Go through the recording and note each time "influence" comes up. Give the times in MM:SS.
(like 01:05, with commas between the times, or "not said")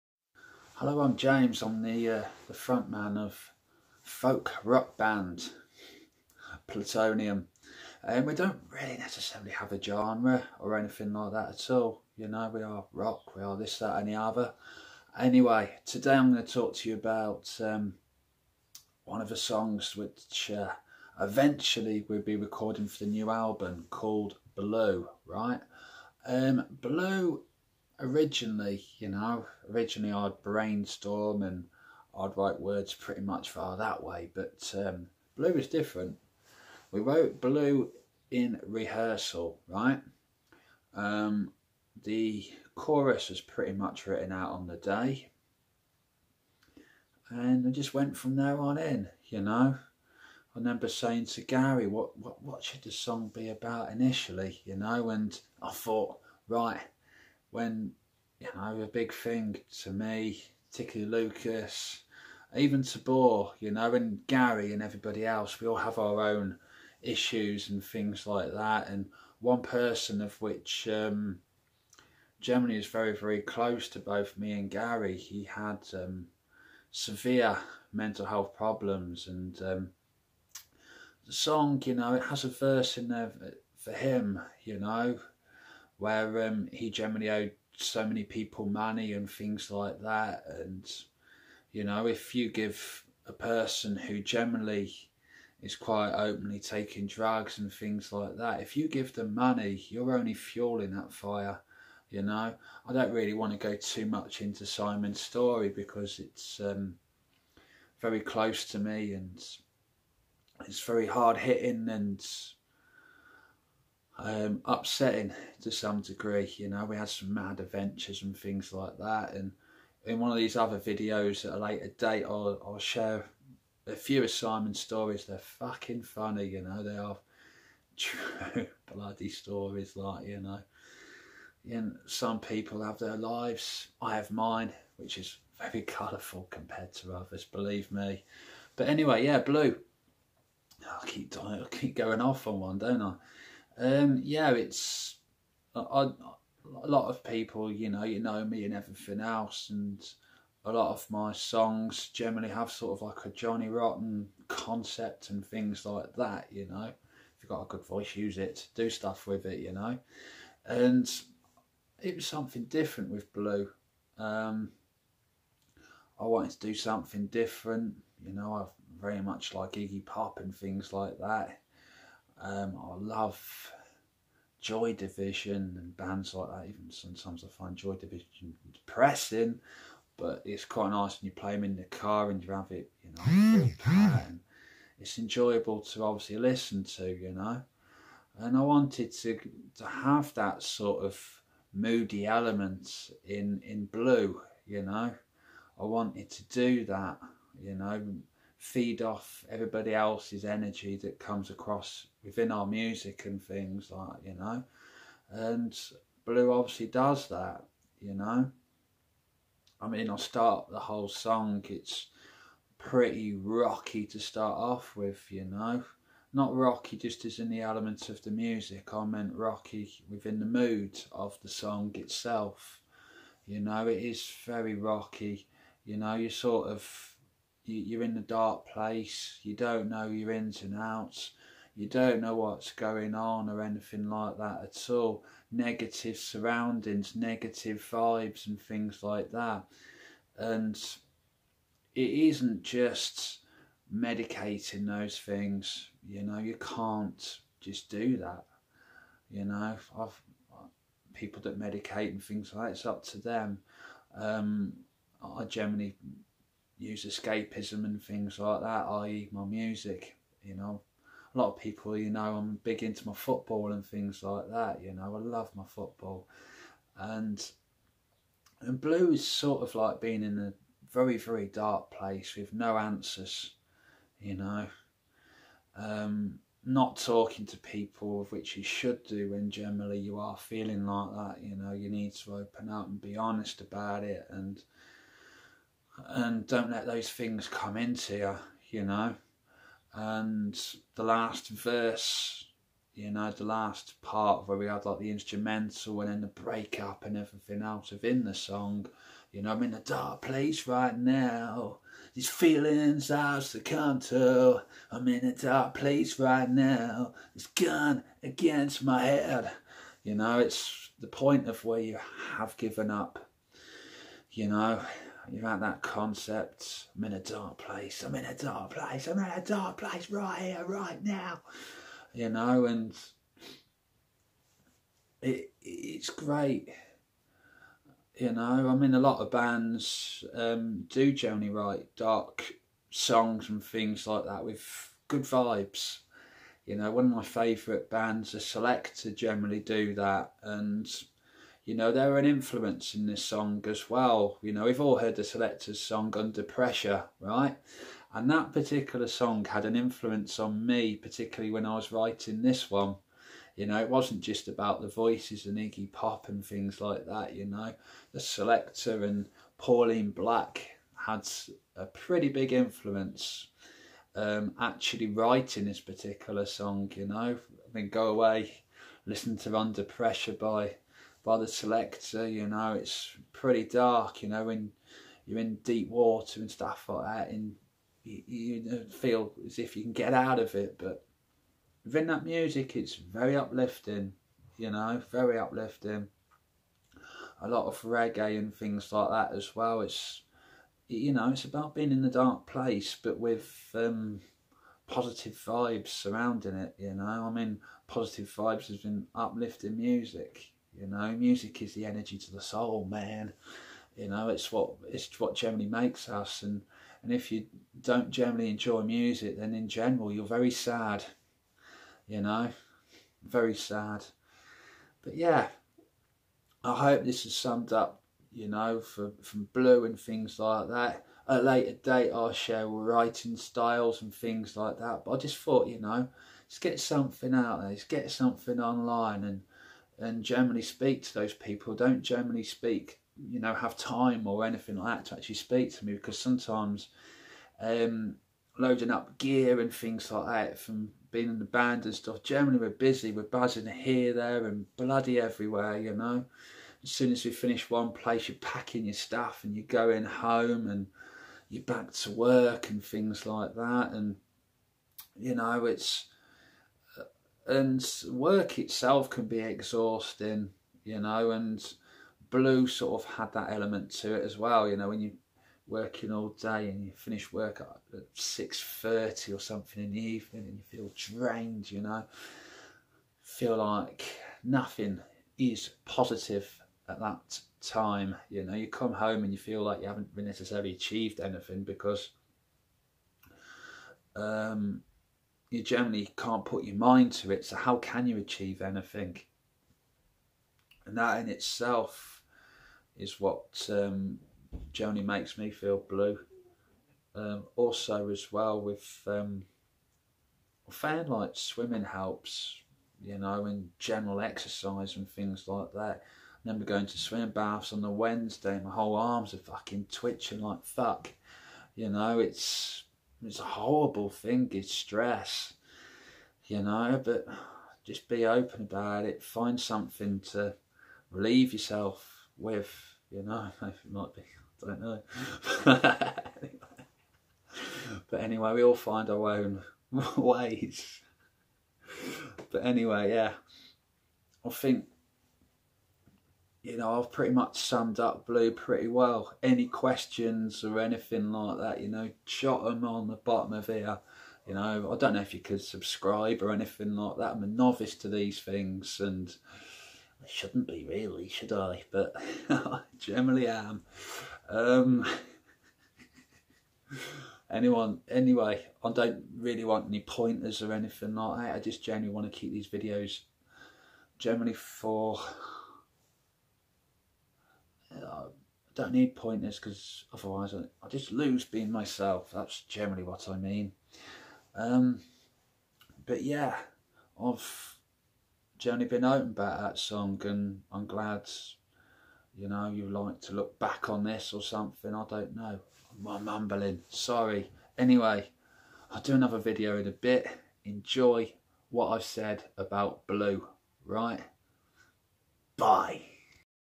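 05:42, 05:49, 06:02.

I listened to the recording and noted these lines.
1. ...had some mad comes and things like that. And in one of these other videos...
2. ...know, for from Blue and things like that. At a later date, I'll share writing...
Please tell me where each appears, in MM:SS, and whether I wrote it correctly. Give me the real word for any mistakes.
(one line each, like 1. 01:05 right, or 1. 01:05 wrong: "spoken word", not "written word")
1. 01:56 wrong: "adventures", not "comes"
2. 06:58 right.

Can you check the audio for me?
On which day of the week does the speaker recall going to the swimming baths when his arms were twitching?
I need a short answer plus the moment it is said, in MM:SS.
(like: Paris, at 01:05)
Wednesday, at 08:27.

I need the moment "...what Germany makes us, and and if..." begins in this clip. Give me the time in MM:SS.
06:45.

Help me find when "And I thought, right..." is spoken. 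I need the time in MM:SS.
00:55.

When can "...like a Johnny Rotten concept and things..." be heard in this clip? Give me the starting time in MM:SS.
02:33.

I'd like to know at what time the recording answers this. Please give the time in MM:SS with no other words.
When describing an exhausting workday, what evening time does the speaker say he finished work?
07:48.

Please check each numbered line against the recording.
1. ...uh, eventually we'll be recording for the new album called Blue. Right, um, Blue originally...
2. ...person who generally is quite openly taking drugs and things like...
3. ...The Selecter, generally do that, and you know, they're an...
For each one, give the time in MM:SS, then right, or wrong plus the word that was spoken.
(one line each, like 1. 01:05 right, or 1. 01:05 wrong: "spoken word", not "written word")
1. 00:20 right
2. 01:33 right
3. 05:38 right.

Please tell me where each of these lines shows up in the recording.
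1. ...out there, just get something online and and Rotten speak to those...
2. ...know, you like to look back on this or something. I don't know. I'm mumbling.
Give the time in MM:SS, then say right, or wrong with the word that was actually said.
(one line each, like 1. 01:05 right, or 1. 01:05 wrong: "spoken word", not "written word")
1. 07:07 wrong: "Germany", not "Rotten"
2. 09:42 right.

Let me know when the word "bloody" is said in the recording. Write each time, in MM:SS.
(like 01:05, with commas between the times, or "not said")
02:08, 07:24.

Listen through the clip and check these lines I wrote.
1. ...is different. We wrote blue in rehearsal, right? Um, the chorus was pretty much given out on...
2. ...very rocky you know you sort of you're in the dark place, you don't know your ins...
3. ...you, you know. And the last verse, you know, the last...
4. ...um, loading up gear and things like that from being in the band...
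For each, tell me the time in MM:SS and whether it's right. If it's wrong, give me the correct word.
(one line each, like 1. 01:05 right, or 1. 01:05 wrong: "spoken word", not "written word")
1. 00:35 wrong: "written", not "given"
2. 03:44 right
3. 04:48 right
4. 07:17 right.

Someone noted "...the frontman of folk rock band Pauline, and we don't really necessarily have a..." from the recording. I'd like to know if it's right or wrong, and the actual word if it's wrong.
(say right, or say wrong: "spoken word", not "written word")
wrong: "Plutonium", not "Pauline".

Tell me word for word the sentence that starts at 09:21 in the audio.
I just generally want to keep these videos generally for I don't need pointers because otherwise I, I, just lose being myself.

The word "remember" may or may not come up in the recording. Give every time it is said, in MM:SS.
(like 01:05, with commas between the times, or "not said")
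00:50, 08:26.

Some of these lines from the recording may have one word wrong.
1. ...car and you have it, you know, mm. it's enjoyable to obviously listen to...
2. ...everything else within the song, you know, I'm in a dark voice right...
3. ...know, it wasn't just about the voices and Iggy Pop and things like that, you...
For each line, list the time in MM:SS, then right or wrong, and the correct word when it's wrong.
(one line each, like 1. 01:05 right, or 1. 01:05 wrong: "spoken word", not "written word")
1. 03:01 right
2. 04:57 wrong: "place", not "voice"
3. 05:53 right.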